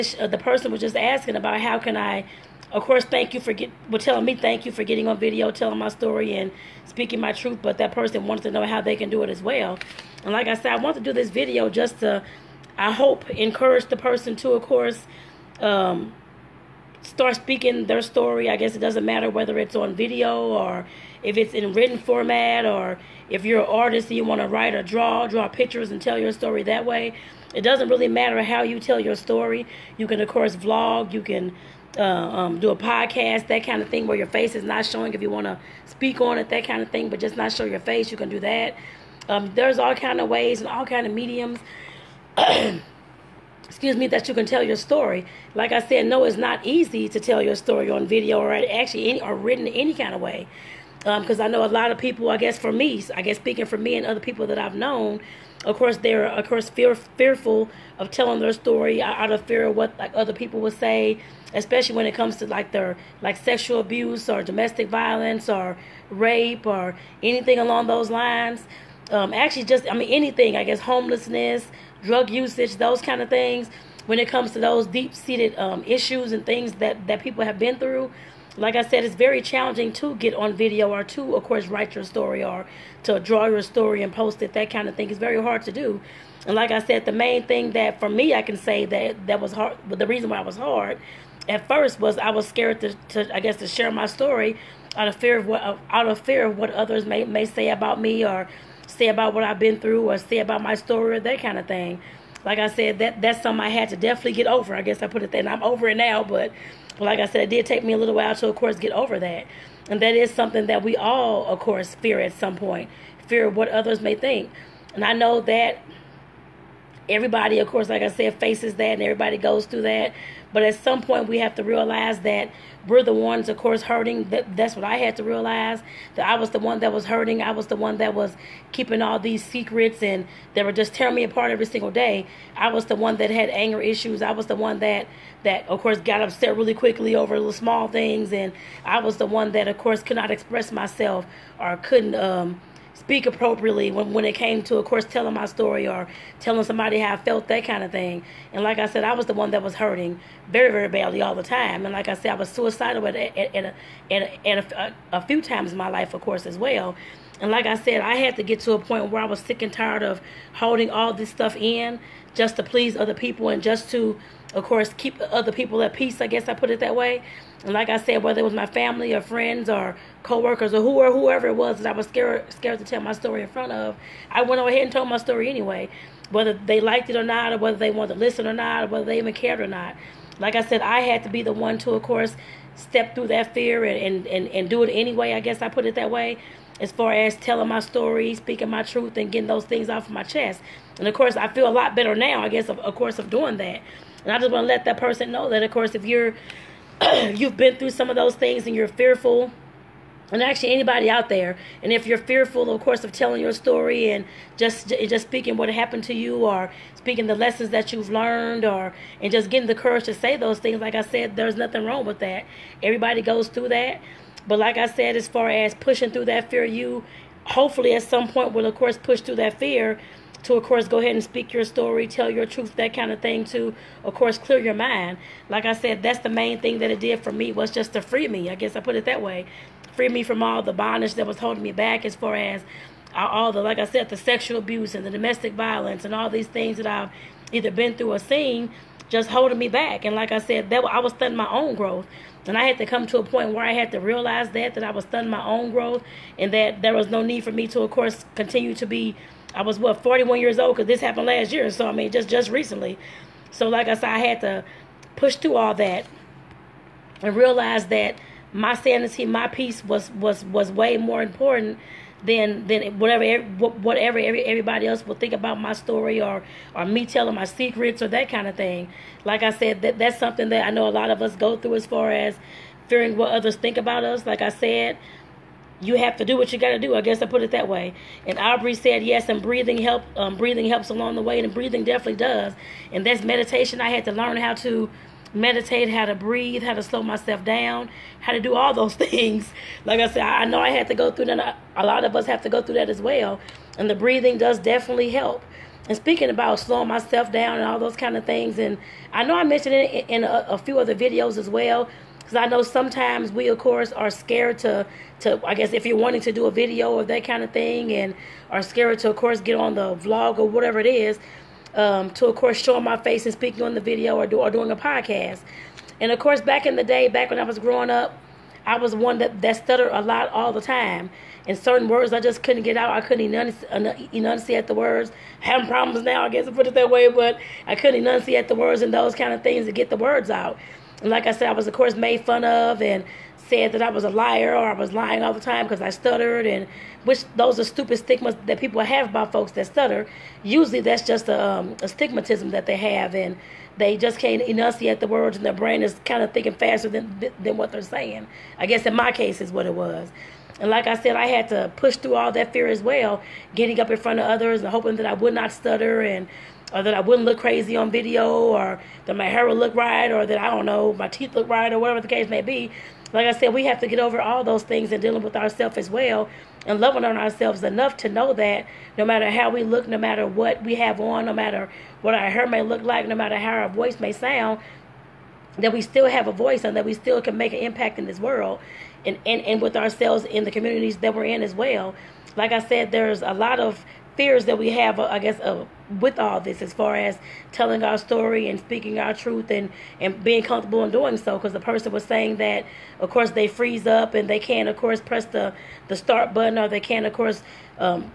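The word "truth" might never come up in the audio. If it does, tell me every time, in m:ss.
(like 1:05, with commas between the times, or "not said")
0:07, 3:08, 3:42, 6:29.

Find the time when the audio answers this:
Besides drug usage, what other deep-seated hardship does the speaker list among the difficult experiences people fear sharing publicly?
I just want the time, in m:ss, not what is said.
1:10.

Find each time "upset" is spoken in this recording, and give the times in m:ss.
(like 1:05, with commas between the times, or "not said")
2:16.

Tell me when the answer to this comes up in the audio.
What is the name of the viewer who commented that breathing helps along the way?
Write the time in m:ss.
4:38.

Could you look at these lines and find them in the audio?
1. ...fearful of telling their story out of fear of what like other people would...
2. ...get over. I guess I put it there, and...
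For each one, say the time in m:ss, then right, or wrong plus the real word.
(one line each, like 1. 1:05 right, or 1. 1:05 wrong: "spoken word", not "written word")
1. 0:56 right
2. 1:44 right.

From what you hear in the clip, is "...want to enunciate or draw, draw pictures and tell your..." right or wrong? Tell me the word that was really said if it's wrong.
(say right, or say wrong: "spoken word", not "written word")
wrong: "write", not "enunciate".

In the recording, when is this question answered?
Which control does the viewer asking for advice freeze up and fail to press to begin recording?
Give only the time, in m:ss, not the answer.
6:35.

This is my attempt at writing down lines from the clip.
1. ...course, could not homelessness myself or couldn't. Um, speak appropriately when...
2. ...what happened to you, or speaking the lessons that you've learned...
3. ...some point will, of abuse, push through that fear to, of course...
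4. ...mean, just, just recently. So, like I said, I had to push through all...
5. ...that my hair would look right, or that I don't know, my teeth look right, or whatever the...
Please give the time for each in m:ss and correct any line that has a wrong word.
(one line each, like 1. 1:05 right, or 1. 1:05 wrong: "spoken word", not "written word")
1. 2:19 wrong: "express", not "homelessness"
2. 3:25 right
3. 3:38 wrong: "course", not "abuse"
4. 4:11 right
5. 5:59 right.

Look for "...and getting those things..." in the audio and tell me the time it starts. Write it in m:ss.
3:09.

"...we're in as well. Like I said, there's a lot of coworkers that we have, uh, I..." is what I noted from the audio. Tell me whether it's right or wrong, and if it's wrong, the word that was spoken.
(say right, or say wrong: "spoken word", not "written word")
wrong: "fears", not "coworkers".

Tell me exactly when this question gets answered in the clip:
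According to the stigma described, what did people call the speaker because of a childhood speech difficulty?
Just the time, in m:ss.
5:34.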